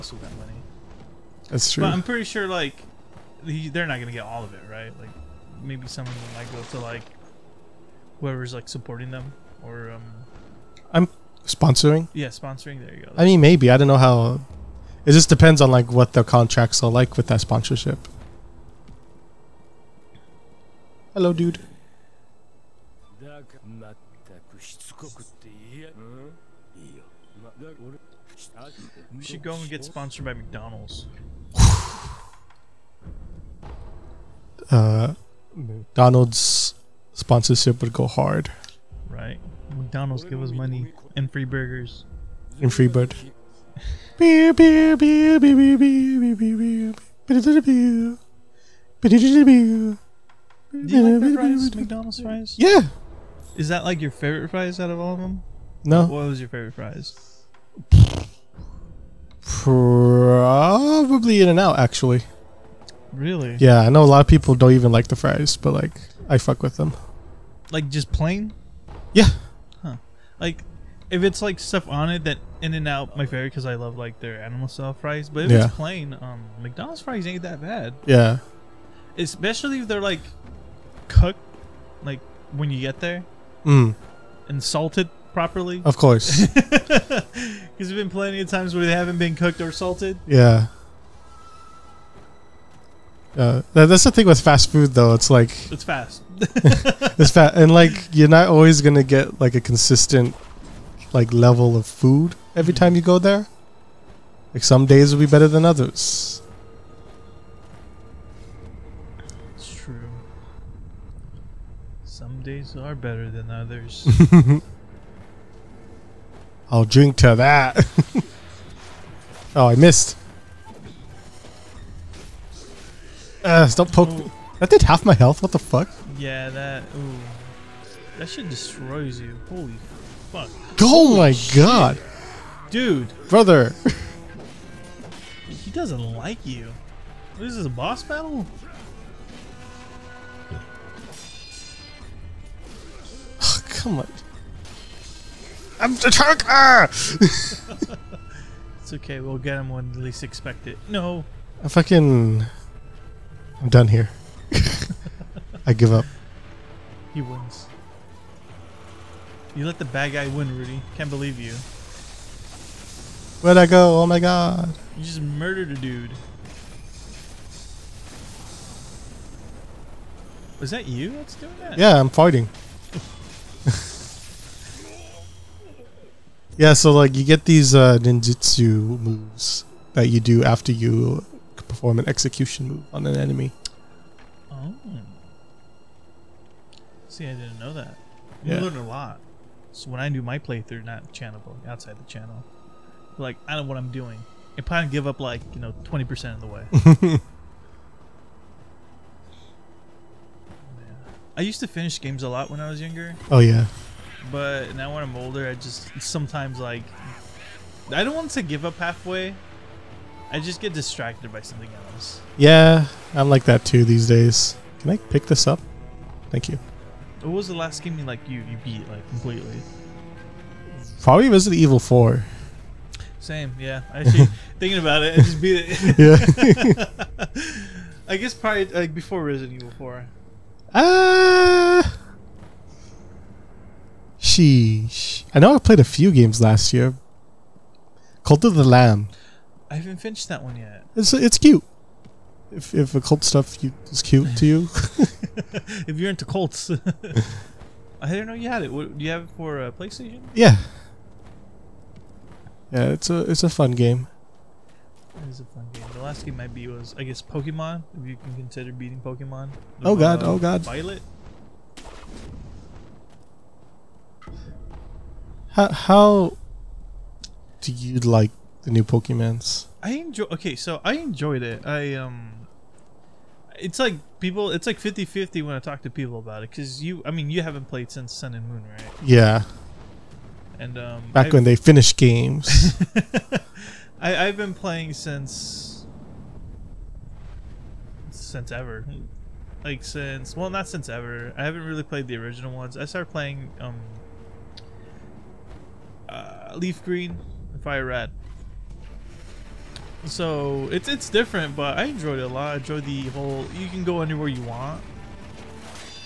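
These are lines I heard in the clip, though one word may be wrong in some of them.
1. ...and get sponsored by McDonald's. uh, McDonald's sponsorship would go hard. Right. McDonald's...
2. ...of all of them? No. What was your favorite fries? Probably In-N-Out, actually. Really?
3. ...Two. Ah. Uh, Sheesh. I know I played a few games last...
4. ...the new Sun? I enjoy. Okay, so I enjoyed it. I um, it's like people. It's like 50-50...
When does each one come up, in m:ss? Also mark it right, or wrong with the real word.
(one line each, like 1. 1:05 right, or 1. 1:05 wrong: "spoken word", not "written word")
1. 0:29 right
2. 0:54 right
3. 3:49 wrong: "Four", not "Two"
4. 4:28 wrong: "Pokemons", not "Sun".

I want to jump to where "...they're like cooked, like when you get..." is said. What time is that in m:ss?
1:19.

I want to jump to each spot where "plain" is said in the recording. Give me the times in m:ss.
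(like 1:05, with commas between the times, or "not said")
1:08, 1:15.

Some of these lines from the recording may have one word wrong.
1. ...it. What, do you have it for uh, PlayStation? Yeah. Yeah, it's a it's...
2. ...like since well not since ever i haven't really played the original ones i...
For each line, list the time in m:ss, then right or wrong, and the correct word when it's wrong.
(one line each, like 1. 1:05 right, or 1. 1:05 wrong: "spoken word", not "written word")
1. 4:08 right
2. 4:49 right.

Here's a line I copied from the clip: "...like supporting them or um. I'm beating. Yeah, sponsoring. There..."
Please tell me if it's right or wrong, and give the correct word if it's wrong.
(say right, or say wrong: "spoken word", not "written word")
wrong: "sponsoring", not "beating".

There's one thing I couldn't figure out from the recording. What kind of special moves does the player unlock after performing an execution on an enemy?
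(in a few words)
ninjutsu moves.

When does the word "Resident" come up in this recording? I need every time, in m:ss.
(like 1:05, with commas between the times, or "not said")
3:41, 3:49.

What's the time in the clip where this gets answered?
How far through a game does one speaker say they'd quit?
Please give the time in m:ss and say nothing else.
3:15.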